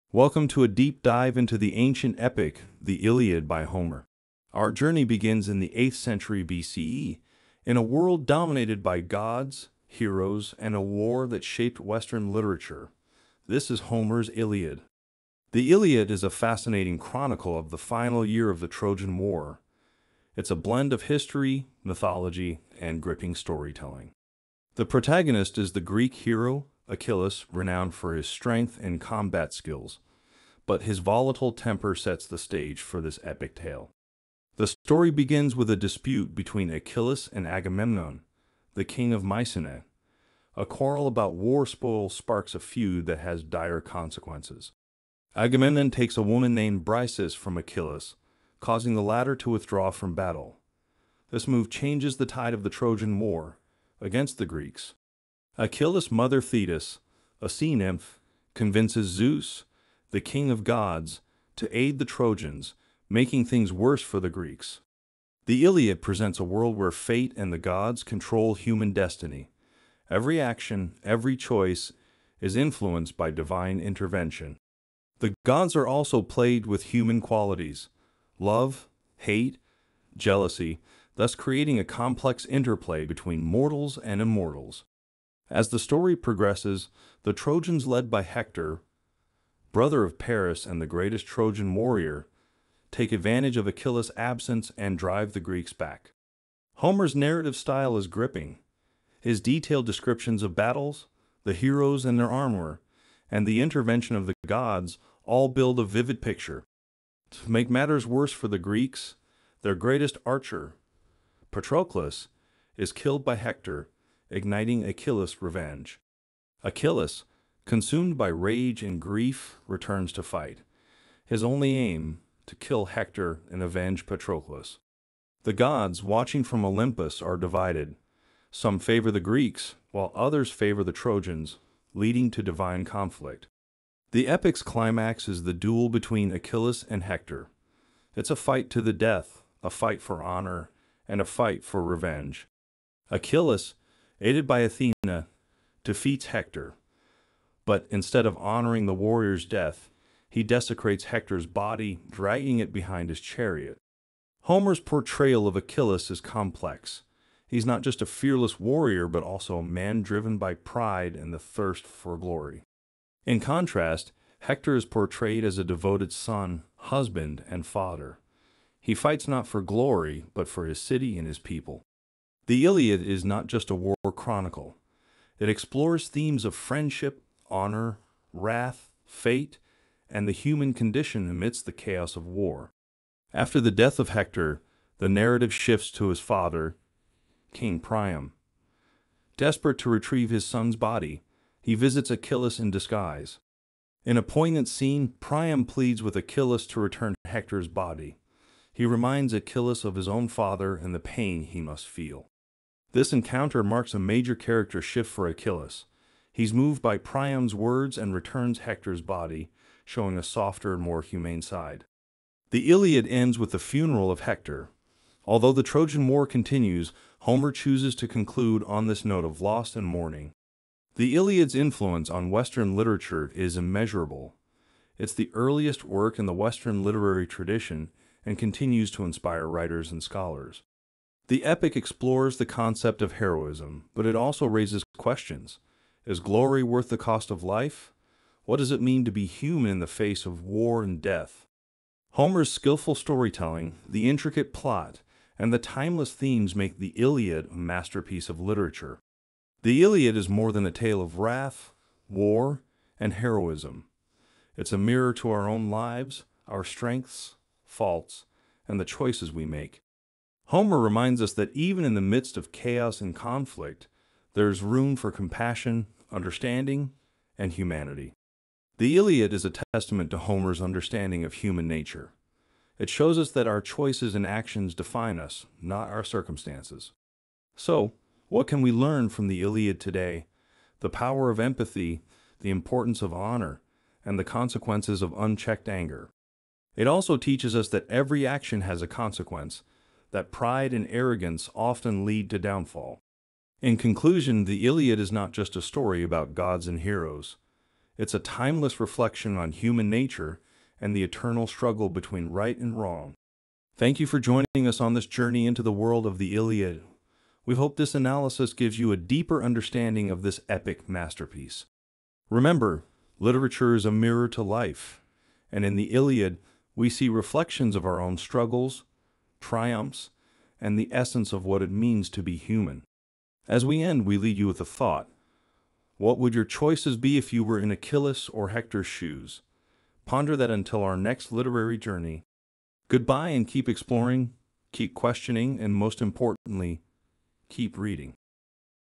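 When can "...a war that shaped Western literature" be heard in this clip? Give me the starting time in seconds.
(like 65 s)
10 s.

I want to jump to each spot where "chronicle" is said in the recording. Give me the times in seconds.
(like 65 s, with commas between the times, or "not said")
16 s, 174 s.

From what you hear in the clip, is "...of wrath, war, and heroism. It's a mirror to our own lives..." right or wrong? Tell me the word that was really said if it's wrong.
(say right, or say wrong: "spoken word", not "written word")
right.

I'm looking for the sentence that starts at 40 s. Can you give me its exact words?
A quarrel about war spoil sparks a feud that has dire consequences.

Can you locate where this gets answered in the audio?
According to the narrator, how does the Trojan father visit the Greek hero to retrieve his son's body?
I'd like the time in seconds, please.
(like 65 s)
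192 s.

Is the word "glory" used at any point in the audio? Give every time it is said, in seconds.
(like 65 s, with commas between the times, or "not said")
162 s, 169 s, 236 s.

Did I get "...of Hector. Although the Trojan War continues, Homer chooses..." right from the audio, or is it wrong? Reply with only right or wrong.
right.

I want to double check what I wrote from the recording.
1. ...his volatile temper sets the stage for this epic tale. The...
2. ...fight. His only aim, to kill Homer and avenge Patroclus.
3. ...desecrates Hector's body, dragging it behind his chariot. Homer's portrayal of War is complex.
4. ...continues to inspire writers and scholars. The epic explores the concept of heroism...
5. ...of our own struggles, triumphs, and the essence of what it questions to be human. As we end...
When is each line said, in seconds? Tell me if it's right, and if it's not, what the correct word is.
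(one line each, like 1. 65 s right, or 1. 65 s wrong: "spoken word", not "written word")
1. 30 s right
2. 120 s wrong: "Hector", not "Homer"
3. 150 s wrong: "Achilles", not "War"
4. 228 s right
5. 317 s wrong: "means", not "questions".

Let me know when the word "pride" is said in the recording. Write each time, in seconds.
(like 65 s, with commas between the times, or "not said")
160 s, 290 s.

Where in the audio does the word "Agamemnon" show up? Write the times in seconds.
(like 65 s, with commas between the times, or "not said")
37 s, 45 s.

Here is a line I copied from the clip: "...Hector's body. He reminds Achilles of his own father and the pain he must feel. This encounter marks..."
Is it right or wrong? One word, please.
right.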